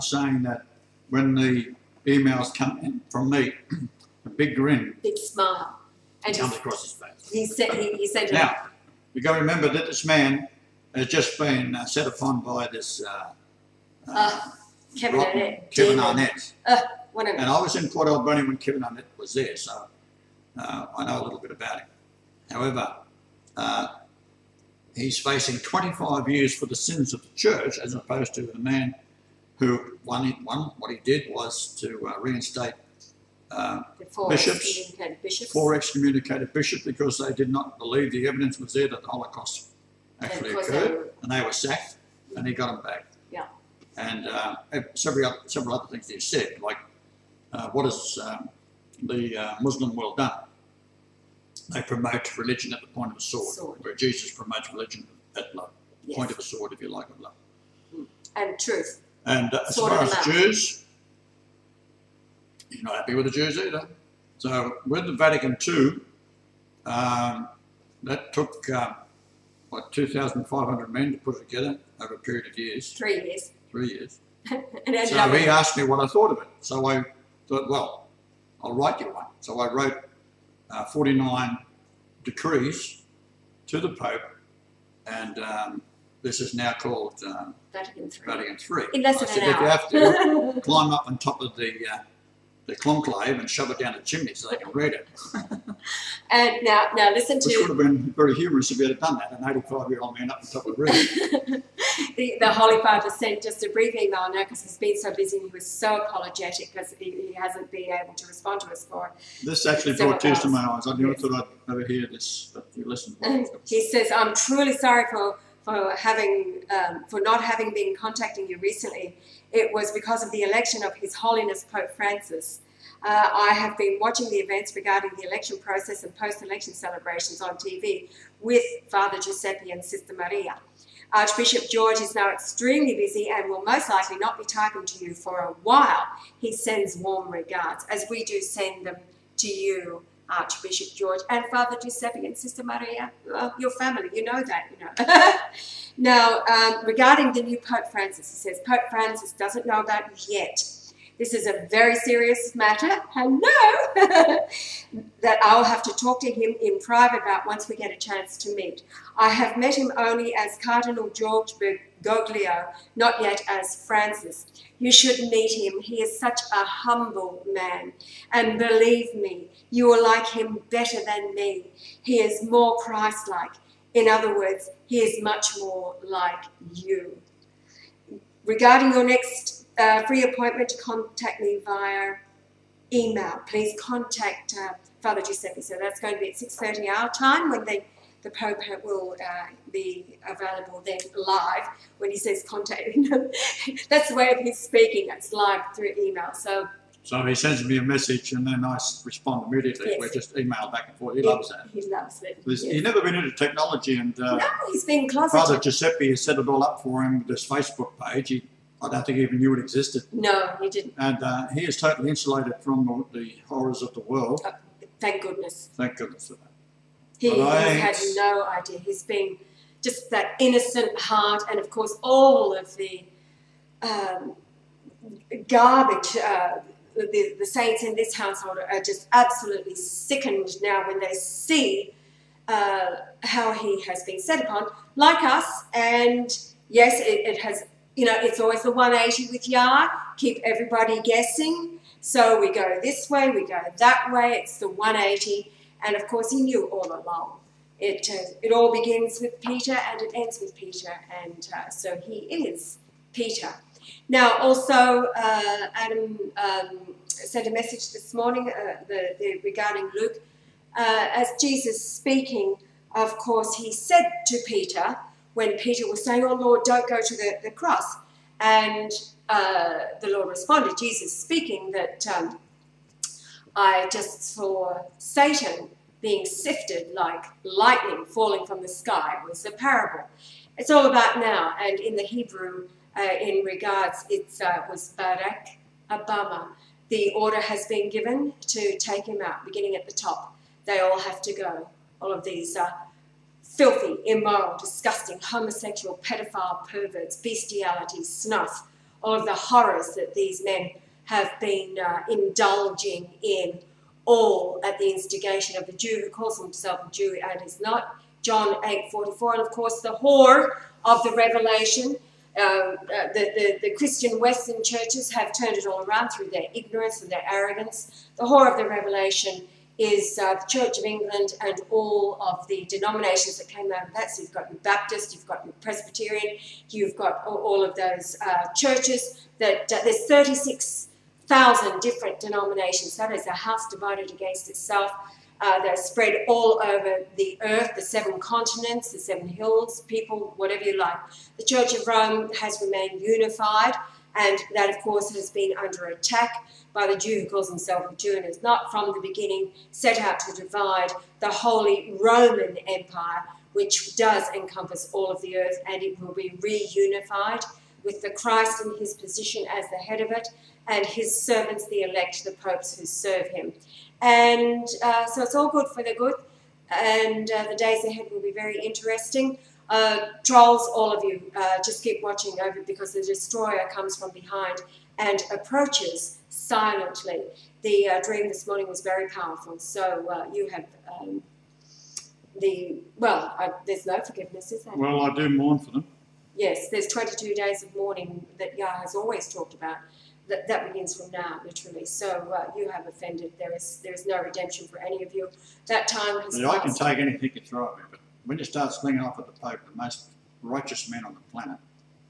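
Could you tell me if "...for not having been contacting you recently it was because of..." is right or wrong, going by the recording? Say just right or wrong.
right.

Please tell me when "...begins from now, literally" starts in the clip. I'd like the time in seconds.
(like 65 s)
390 s.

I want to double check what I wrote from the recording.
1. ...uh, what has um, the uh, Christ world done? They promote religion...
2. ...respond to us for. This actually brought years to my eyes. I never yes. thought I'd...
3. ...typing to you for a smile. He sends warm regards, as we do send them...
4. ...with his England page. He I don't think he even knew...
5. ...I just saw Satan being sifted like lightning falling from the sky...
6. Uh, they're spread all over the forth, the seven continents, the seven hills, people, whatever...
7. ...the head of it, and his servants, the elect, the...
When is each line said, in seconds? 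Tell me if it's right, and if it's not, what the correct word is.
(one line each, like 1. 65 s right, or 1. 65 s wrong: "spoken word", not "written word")
1. 47 s wrong: "Muslim", not "Christ"
2. 108 s wrong: "tears", not "years"
3. 134 s wrong: "while", not "smile"
4. 207 s wrong: "Facebook", not "England"
5. 273 s right
6. 335 s wrong: "earth", not "forth"
7. 359 s right.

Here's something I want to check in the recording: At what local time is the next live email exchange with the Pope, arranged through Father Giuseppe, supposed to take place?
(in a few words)
6:30.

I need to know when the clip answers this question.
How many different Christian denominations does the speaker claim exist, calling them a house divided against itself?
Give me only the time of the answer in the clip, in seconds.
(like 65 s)
330 s.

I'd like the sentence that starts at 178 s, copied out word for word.
Regarding your next uh, free appointment to contact me via email.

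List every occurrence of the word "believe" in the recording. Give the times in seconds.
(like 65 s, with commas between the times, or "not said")
37 s, 168 s.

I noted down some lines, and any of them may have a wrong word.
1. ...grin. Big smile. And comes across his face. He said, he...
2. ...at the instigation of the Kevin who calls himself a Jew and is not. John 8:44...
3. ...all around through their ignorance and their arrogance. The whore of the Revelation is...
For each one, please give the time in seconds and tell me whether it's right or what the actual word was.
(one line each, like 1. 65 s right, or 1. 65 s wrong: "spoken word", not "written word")
1. 4 s right
2. 304 s wrong: "Jew", not "Kevin"
3. 315 s right.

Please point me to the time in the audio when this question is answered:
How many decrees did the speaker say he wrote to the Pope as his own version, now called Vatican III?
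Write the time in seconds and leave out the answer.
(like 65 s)
80 s.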